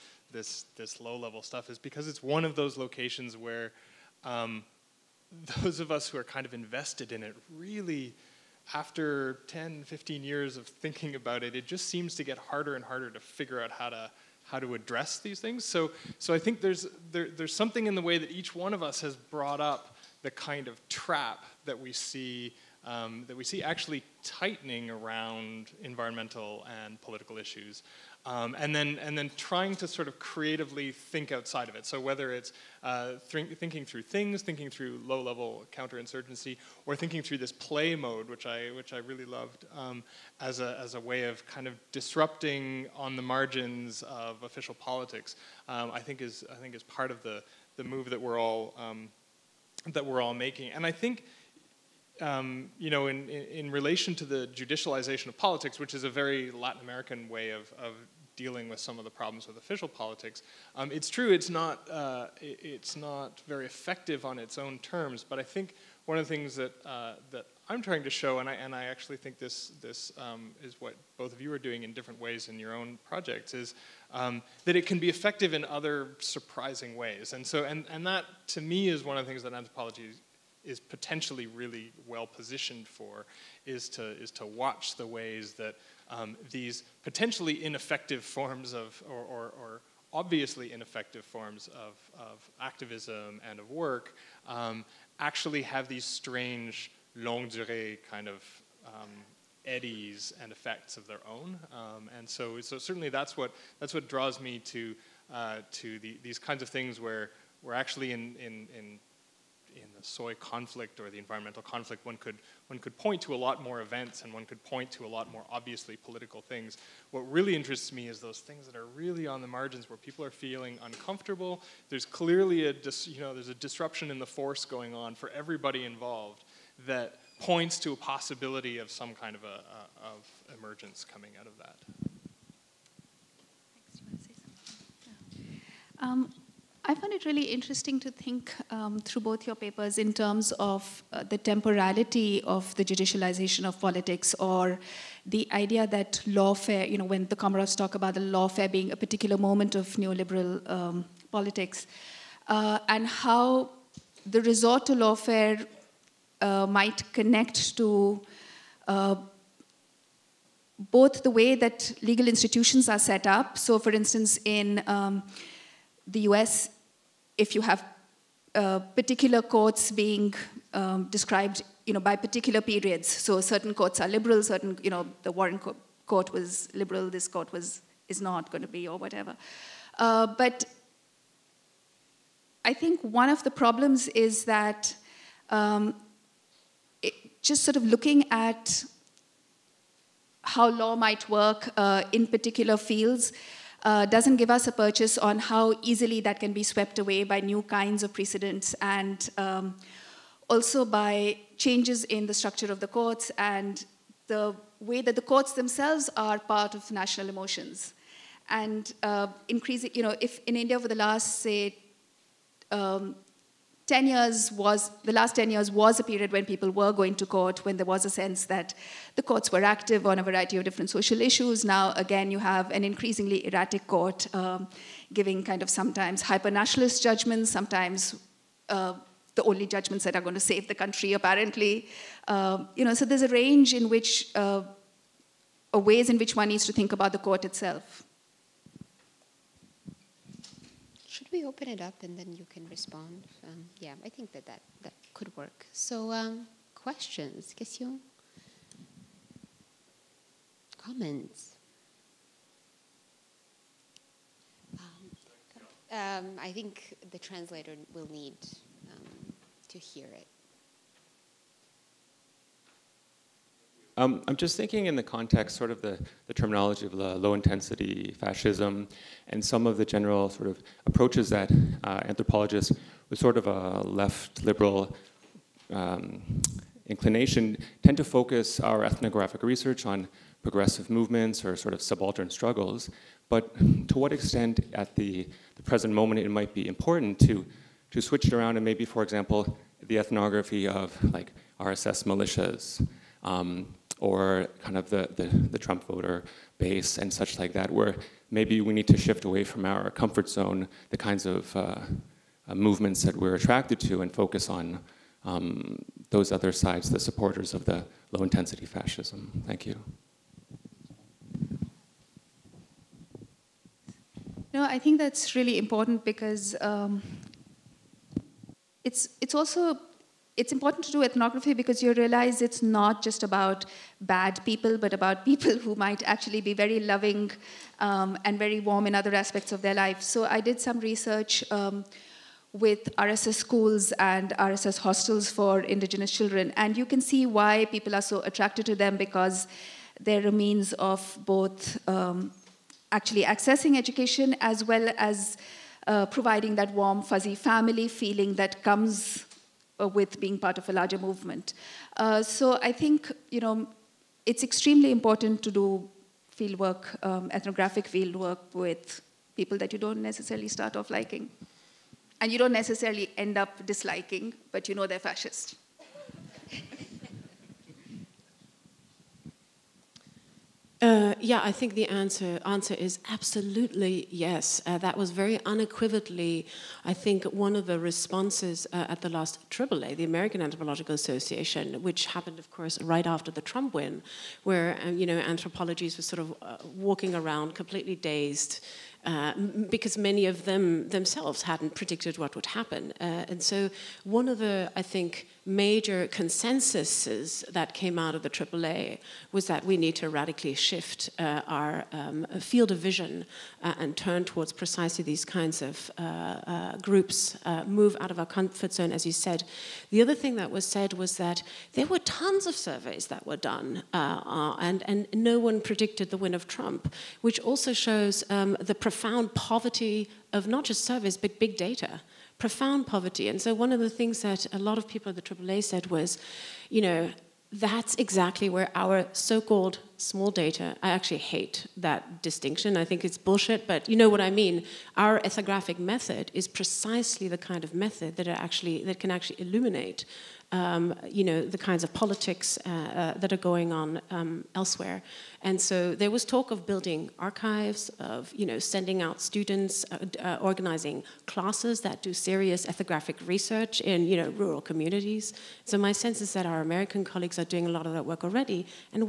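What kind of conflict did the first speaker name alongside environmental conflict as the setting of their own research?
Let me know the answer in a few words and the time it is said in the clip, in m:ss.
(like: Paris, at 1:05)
soy conflict, at 1:50.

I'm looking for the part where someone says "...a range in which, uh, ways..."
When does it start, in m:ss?
3:53.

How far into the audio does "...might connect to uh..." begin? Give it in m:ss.
2:36.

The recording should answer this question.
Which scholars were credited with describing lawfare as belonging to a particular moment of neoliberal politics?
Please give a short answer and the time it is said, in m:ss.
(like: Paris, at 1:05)
the Comaroffs, at 2:27.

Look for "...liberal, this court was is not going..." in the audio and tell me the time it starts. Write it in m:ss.
2:56.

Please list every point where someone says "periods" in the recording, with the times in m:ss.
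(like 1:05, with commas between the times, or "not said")
2:52, 3:36.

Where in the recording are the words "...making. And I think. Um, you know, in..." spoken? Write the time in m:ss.
0:50.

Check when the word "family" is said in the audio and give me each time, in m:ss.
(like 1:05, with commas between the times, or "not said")
5:47.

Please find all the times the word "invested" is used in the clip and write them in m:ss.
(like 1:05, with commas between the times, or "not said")
0:06.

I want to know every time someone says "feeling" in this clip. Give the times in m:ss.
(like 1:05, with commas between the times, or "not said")
2:00, 5:47.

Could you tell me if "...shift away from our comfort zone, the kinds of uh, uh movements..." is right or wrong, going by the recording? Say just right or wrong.
right.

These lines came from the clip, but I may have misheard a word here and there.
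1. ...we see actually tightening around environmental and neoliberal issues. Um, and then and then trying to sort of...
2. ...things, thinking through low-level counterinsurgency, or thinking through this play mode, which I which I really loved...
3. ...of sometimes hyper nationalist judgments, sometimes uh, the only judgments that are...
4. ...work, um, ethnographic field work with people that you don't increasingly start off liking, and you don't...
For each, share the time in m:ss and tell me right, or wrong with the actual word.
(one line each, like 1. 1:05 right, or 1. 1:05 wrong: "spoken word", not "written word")
1. 0:23 wrong: "political", not "neoliberal"
2. 0:34 right
3. 3:45 right
4. 5:56 wrong: "necessarily", not "increasingly".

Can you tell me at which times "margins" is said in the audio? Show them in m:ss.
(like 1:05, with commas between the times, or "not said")
0:43, 1:59.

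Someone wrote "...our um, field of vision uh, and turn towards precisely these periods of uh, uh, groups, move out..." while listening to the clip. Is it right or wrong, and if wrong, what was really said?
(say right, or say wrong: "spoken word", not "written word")
wrong: "kinds", not "periods".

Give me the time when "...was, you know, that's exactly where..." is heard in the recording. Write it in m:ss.
7:05.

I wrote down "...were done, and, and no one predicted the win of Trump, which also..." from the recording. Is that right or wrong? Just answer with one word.
right.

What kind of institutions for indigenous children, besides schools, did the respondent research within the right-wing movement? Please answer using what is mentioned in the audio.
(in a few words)
RSS hostels.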